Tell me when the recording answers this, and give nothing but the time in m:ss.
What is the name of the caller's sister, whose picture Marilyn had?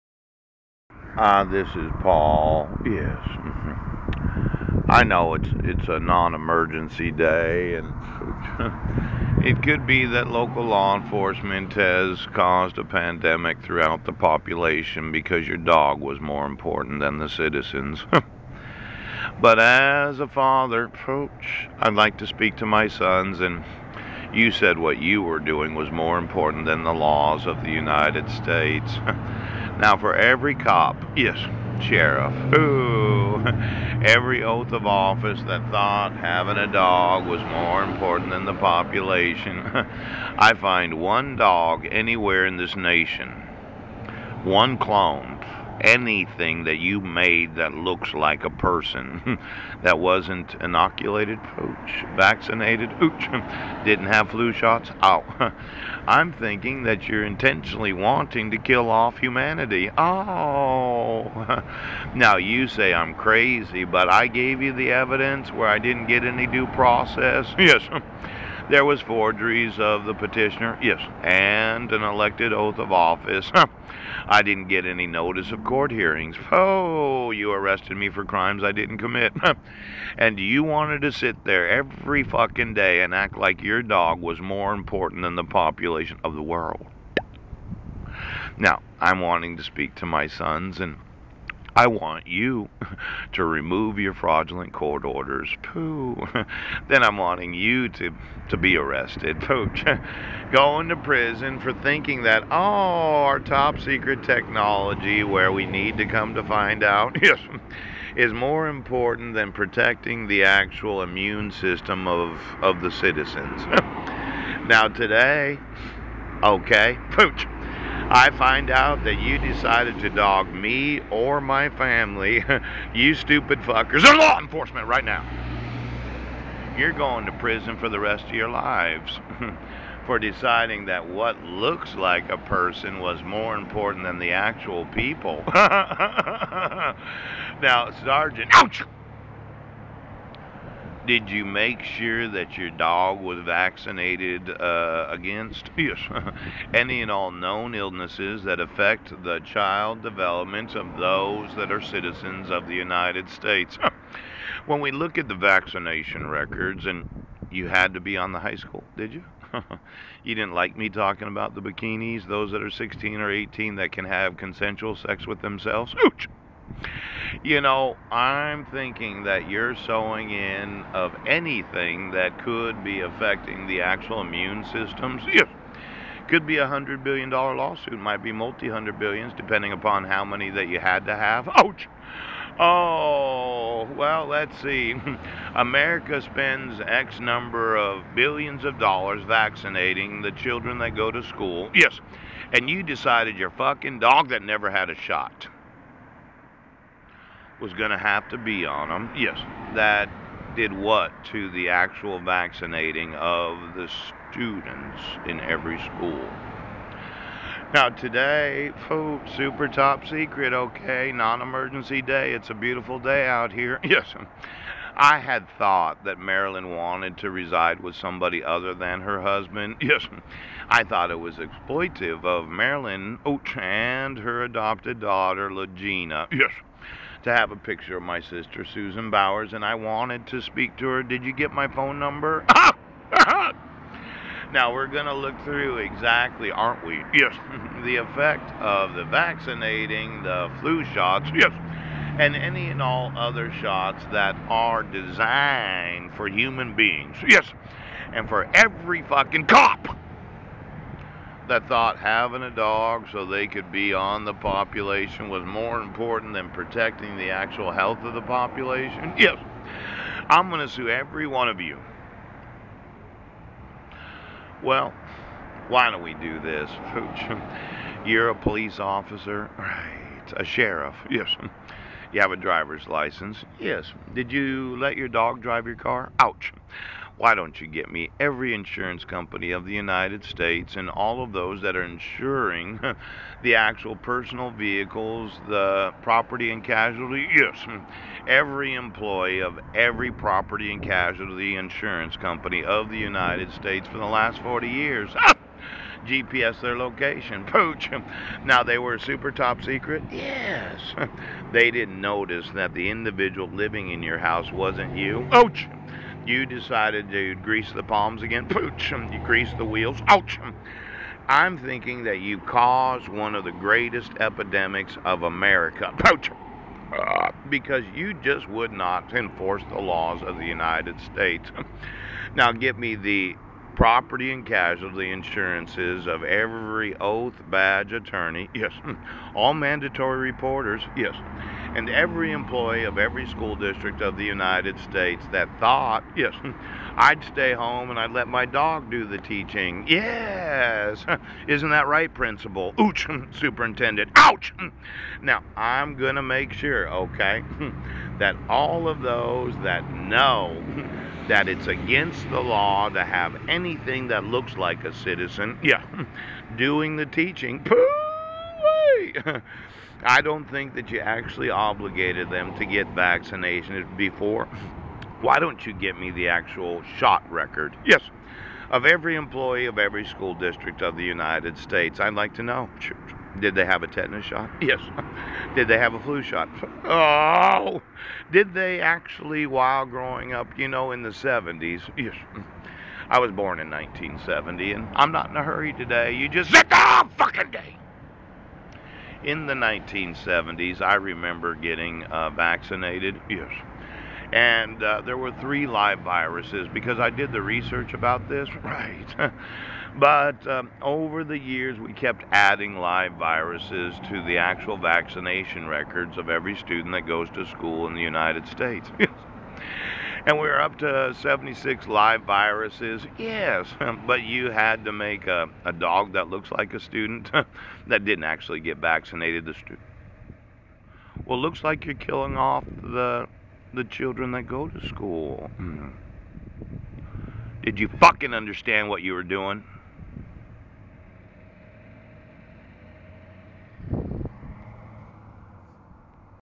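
3:48.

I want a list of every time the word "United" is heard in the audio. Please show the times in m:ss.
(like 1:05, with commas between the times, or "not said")
0:27, 2:32, 4:39, 4:52, 5:20, 5:34, 6:11, 6:48.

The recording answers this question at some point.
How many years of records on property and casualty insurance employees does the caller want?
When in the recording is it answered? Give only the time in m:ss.
4:54.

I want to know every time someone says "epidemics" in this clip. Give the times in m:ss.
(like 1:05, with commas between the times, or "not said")
5:14.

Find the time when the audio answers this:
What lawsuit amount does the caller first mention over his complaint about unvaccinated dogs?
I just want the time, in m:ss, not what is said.
2:56.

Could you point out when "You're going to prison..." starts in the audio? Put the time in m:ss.
2:06.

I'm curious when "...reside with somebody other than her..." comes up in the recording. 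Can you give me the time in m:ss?
3:37.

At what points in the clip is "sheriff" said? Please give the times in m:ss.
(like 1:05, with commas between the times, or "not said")
0:31, 4:30.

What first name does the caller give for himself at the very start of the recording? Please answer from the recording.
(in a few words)
Paul.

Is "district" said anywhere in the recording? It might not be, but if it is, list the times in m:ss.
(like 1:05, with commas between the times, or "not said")
5:33, 6:10.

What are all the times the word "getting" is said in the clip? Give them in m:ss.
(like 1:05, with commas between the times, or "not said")
6:31.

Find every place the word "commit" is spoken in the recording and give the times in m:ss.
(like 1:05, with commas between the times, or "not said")
1:18.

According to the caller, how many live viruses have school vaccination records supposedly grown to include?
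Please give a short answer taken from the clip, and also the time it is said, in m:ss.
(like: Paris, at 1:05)
76, at 6:51.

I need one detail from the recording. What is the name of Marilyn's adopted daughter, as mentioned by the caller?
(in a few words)
Legina.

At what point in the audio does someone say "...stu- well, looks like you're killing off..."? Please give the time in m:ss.
6:59.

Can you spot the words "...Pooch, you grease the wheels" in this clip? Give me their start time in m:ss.
5:08.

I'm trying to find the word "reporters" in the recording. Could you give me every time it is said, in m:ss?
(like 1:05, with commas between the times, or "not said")
5:30.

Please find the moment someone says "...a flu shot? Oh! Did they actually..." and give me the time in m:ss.
6:15.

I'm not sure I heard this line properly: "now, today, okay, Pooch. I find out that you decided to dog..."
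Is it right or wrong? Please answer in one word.
right.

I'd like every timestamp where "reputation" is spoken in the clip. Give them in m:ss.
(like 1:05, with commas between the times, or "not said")
not said.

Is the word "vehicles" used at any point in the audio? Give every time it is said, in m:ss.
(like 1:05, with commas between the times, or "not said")
4:44.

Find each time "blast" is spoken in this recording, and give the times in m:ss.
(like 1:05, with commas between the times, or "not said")
not said.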